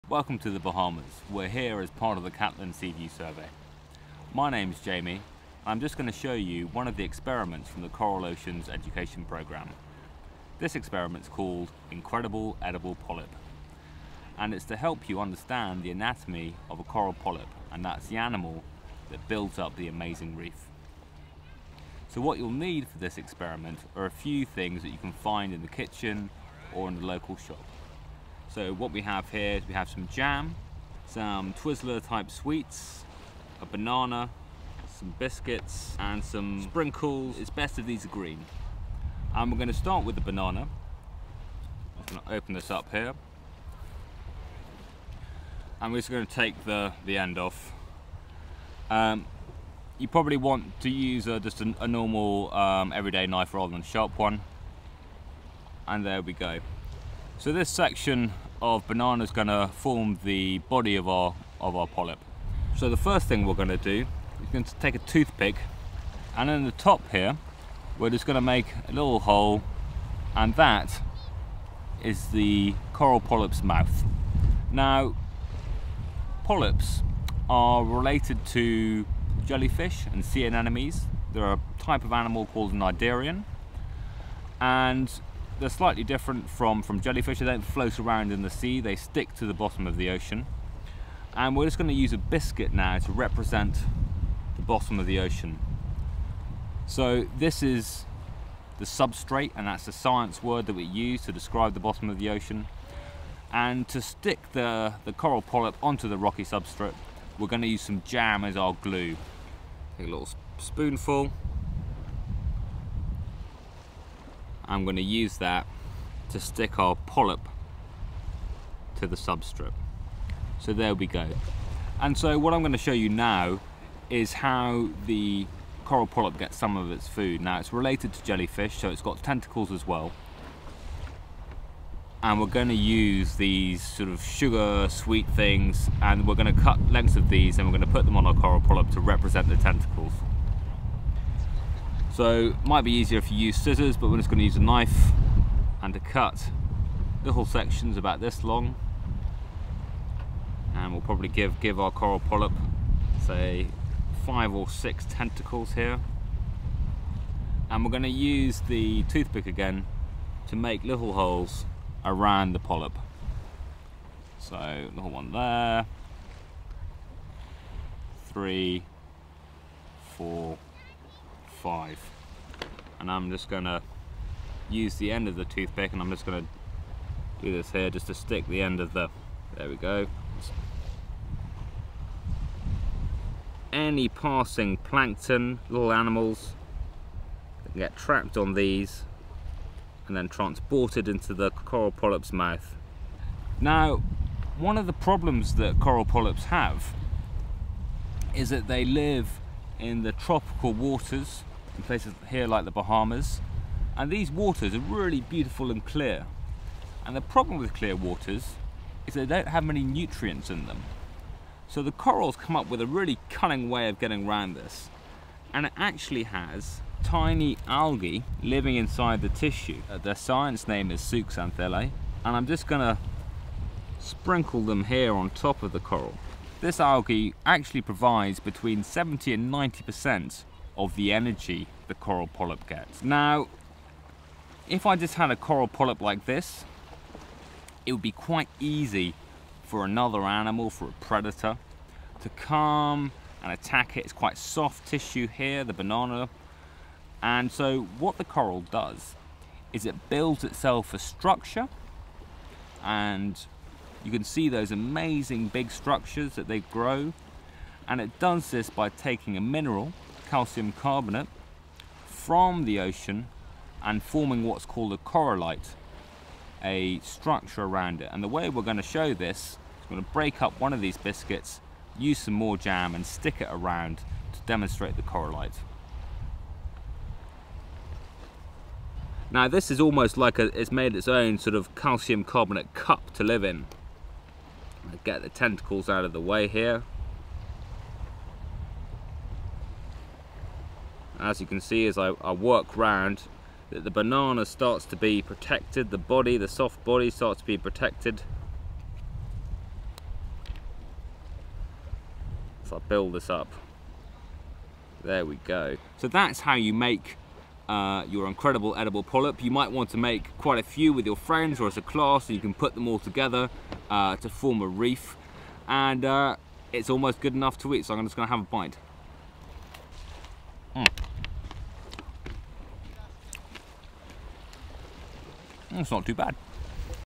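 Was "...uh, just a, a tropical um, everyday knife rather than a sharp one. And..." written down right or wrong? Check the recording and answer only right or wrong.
wrong.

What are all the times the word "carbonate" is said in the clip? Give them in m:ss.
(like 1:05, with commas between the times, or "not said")
4:20, 4:42.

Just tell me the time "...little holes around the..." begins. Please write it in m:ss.
2:40.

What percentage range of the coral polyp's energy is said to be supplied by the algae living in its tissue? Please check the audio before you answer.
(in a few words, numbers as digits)
70 to 90%.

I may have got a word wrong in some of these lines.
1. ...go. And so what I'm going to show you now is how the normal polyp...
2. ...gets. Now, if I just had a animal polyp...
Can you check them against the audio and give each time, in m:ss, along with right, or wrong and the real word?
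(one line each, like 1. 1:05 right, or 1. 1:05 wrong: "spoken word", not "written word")
1. 2:01 wrong: "coral", not "normal"
2. 3:52 wrong: "coral", not "animal".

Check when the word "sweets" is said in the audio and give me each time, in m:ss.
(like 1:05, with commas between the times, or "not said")
0:32, 2:14.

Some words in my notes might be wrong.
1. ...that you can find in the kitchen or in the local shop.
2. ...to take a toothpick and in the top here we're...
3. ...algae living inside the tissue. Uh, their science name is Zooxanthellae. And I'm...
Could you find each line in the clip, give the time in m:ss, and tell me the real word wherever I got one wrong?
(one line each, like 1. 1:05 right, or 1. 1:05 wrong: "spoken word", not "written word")
1. 0:24 right
2. 1:04 right
3. 3:37 right.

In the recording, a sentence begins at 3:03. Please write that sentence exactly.
Any passing plankton, little animals, get trapped on these and then transported into the coral polyp's mouth.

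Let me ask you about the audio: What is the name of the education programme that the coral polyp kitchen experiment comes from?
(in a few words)
Coral Oceans Education Programme.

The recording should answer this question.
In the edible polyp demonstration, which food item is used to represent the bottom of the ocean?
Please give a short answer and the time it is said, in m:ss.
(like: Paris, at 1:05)
a biscuit, at 1:32.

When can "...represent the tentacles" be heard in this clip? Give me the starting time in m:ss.
2:19.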